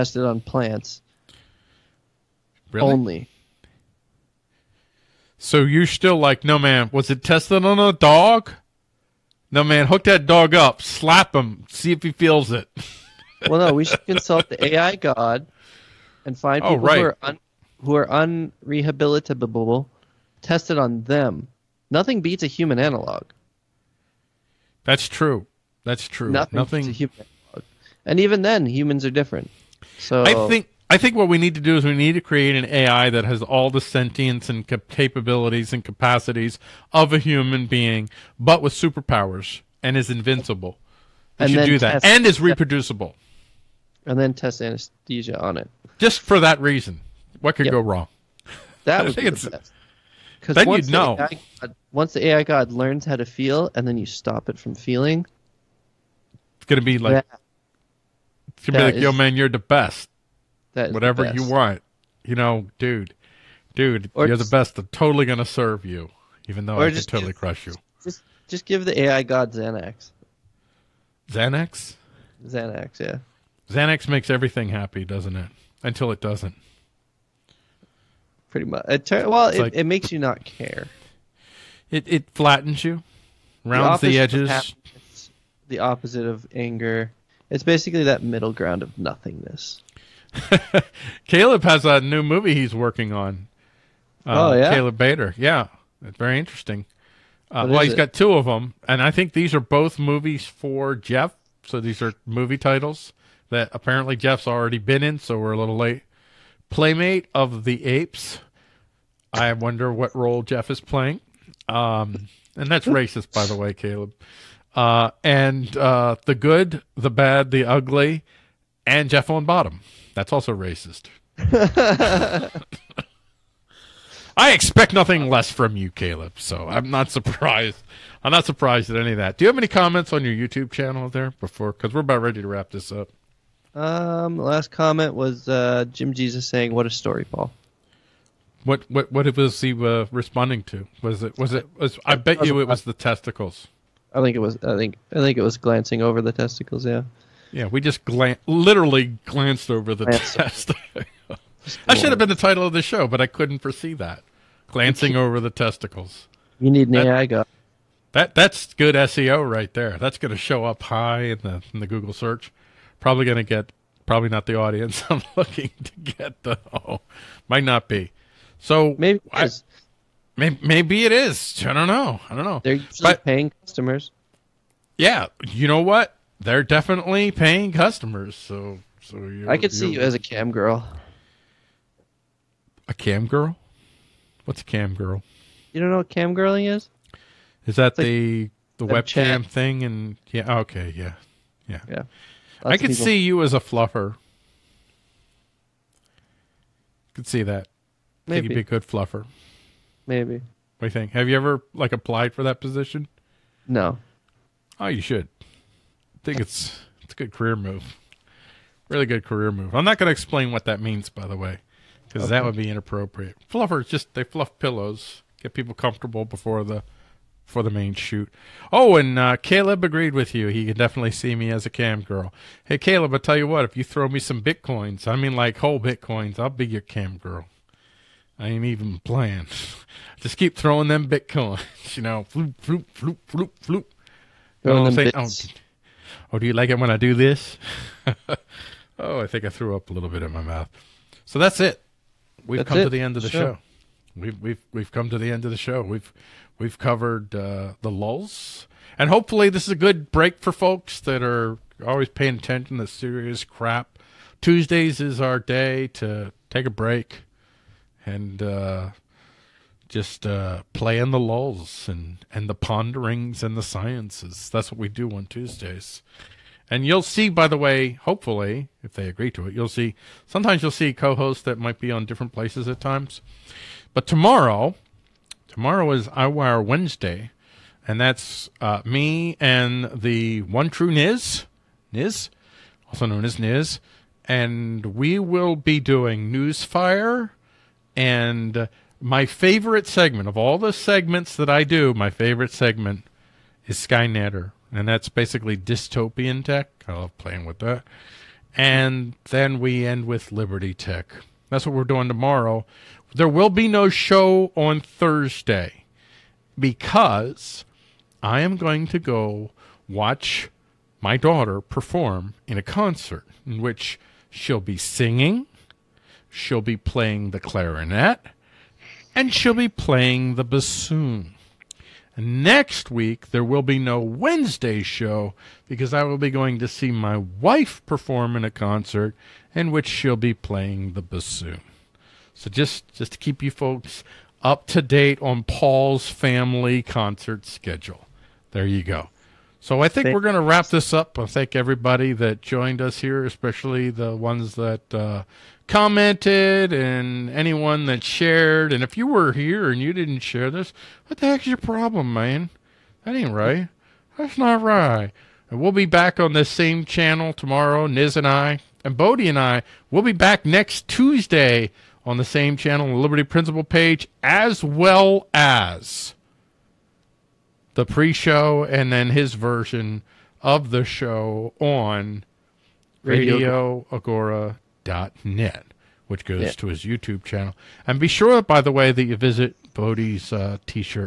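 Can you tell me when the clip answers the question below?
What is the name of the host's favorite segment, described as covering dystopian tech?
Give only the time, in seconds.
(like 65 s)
293 s.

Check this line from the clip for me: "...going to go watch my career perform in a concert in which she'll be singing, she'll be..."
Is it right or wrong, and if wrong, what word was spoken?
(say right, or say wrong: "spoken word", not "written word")
wrong: "daughter", not "career".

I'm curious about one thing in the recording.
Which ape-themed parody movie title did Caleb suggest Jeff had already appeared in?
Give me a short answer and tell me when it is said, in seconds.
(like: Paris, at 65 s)
Playmate of the Apes, at 106 s.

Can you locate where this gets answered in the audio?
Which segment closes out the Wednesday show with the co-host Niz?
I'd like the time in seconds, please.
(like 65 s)
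300 s.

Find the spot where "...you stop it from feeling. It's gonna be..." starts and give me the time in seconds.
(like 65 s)
53 s.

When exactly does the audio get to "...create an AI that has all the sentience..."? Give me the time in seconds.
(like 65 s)
32 s.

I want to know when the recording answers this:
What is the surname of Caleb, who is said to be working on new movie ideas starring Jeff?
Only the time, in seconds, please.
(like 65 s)
94 s.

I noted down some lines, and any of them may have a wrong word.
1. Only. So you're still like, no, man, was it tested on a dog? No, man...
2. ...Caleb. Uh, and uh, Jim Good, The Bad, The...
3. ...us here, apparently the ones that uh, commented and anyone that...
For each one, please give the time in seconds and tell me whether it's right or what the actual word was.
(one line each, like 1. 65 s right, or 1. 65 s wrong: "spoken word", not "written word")
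1. 2 s right
2. 113 s wrong: "The", not "Jim"
3. 342 s wrong: "especially", not "apparently".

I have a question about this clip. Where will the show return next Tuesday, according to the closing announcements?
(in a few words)
Liberty Principle.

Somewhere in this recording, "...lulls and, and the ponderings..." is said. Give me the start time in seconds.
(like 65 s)
261 s.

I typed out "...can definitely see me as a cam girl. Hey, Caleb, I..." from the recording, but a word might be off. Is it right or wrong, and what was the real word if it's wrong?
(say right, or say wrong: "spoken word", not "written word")
right.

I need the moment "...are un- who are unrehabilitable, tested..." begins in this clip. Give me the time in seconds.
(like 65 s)
17 s.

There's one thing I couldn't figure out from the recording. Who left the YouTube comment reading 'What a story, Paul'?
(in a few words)
Jim Jesus.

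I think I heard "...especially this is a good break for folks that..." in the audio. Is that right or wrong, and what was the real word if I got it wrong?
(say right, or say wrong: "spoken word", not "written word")
wrong: "hopefully", not "especially".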